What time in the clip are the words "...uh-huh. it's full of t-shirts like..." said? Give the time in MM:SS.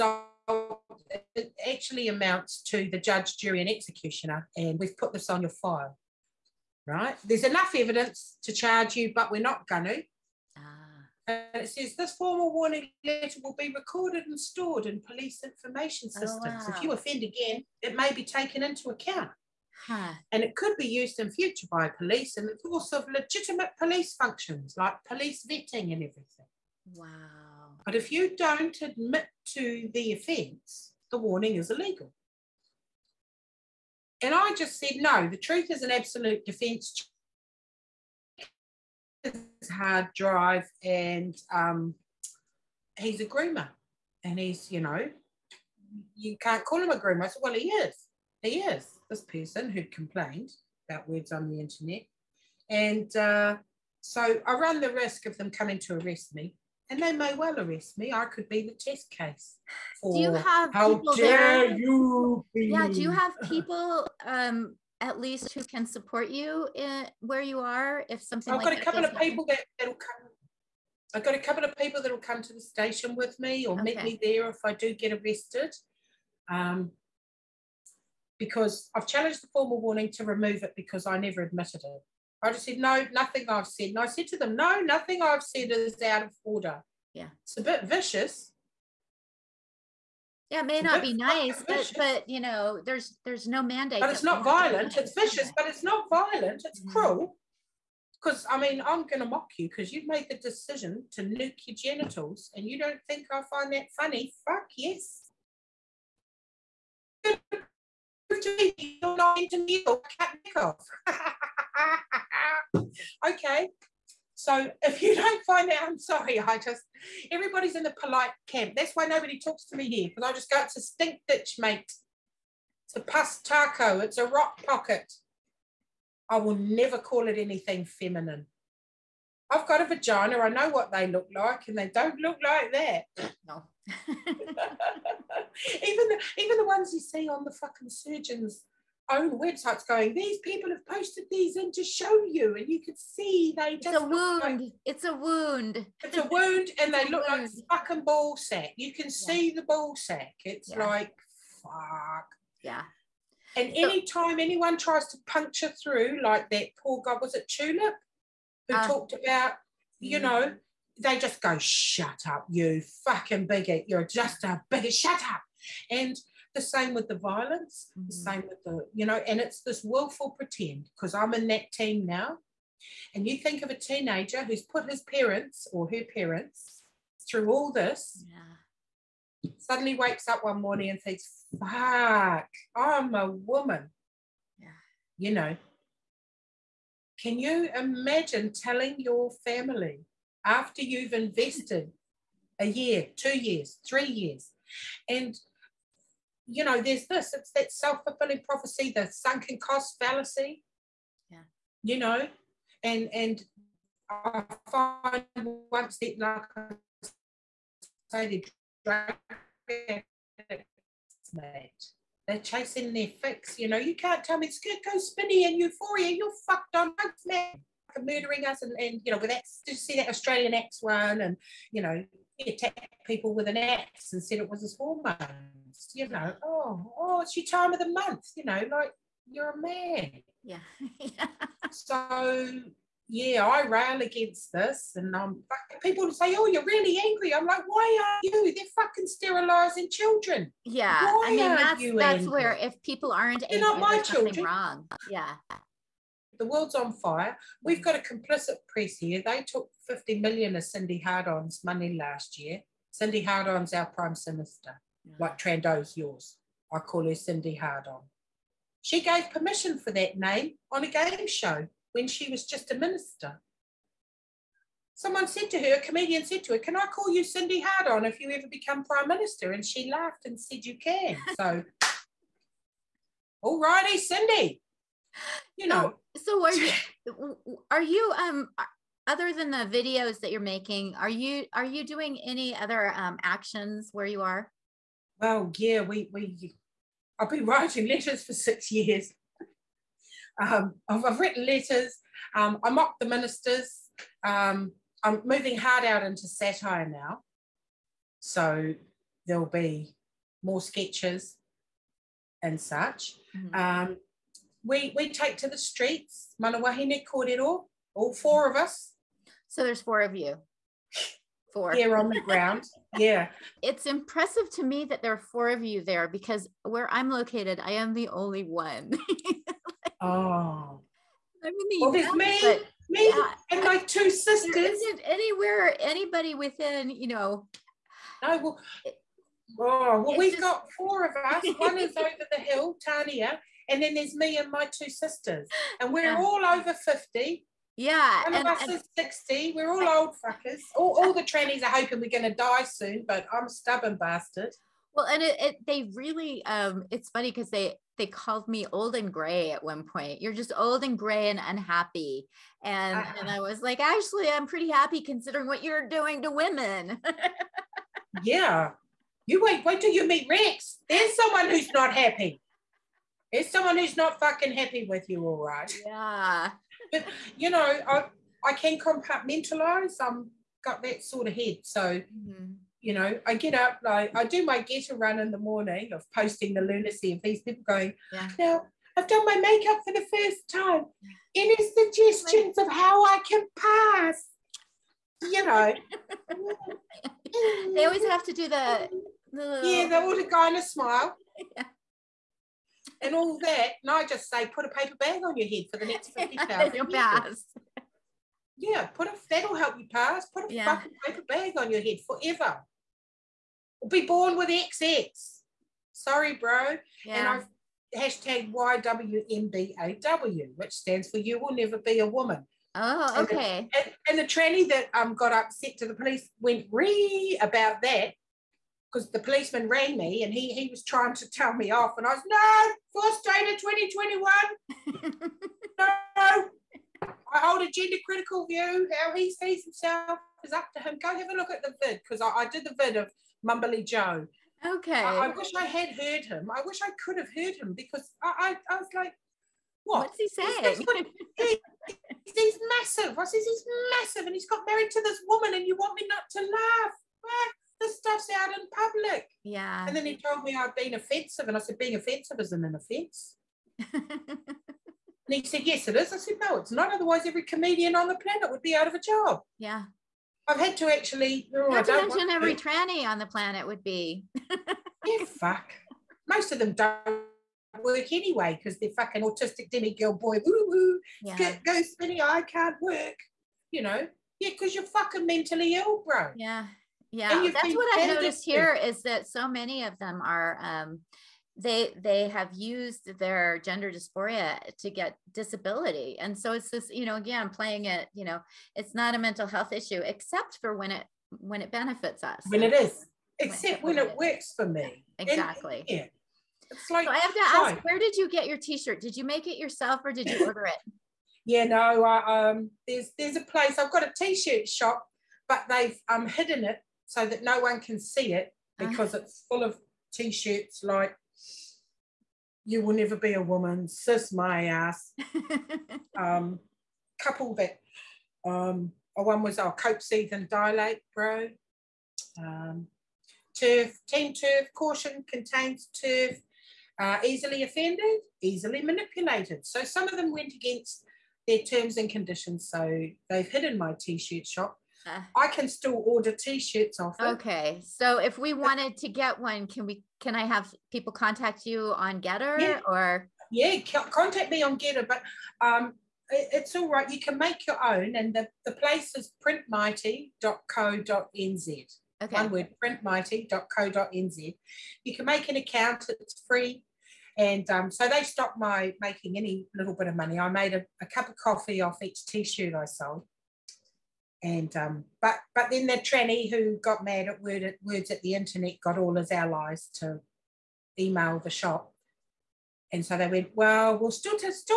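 08:29.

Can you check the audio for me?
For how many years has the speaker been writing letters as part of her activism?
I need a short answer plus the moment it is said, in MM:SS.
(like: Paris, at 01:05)
6 years, at 04:48.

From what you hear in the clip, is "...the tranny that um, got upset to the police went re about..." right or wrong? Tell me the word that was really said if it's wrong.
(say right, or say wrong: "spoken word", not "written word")
right.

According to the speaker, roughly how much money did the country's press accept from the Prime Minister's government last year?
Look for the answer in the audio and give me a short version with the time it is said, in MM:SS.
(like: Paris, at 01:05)
50 million, at 04:09.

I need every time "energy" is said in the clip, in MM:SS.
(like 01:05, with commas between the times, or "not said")
not said.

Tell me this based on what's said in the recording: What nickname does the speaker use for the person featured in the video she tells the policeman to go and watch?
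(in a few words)
Mumbly Joe.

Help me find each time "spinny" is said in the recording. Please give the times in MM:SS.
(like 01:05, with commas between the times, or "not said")
03:34, 07:51.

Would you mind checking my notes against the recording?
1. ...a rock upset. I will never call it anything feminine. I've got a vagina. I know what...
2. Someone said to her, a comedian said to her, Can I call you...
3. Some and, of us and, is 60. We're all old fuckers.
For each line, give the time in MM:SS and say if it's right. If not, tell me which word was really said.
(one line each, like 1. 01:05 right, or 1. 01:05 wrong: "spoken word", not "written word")
1. 02:04 wrong: "pocket", not "upset"
2. 04:24 right
3. 05:38 right.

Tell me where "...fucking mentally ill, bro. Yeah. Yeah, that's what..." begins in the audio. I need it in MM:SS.
07:54.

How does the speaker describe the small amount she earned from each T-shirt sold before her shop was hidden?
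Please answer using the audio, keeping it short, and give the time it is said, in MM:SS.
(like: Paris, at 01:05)
A cup of coffee, at 09:21.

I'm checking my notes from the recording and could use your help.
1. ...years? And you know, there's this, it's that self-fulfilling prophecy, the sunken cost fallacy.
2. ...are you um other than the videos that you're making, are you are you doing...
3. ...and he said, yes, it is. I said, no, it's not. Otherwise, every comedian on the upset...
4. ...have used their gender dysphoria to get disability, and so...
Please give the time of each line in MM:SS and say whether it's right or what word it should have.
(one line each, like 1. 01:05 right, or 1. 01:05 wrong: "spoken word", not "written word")
1. 03:14 right
2. 04:37 right
3. 07:33 wrong: "planet", not "upset"
4. 08:02 right.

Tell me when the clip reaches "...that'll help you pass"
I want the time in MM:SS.
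06:39.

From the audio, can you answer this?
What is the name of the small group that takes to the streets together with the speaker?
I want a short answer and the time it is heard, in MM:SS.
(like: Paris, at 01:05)
Mana Wahine Korero, at 05:06.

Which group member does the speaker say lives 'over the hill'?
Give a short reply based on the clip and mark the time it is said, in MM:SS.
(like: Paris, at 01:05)
Tania, at 05:32.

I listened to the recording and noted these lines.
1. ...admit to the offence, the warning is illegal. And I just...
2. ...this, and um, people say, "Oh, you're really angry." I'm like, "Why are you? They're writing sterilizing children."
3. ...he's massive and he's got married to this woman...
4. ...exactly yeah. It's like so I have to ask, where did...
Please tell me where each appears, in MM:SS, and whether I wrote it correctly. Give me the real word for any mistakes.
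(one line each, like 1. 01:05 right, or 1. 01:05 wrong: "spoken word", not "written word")
1. 00:28 right
2. 03:54 wrong: "fucking", not "writing"
3. 07:23 right
4. 08:15 right.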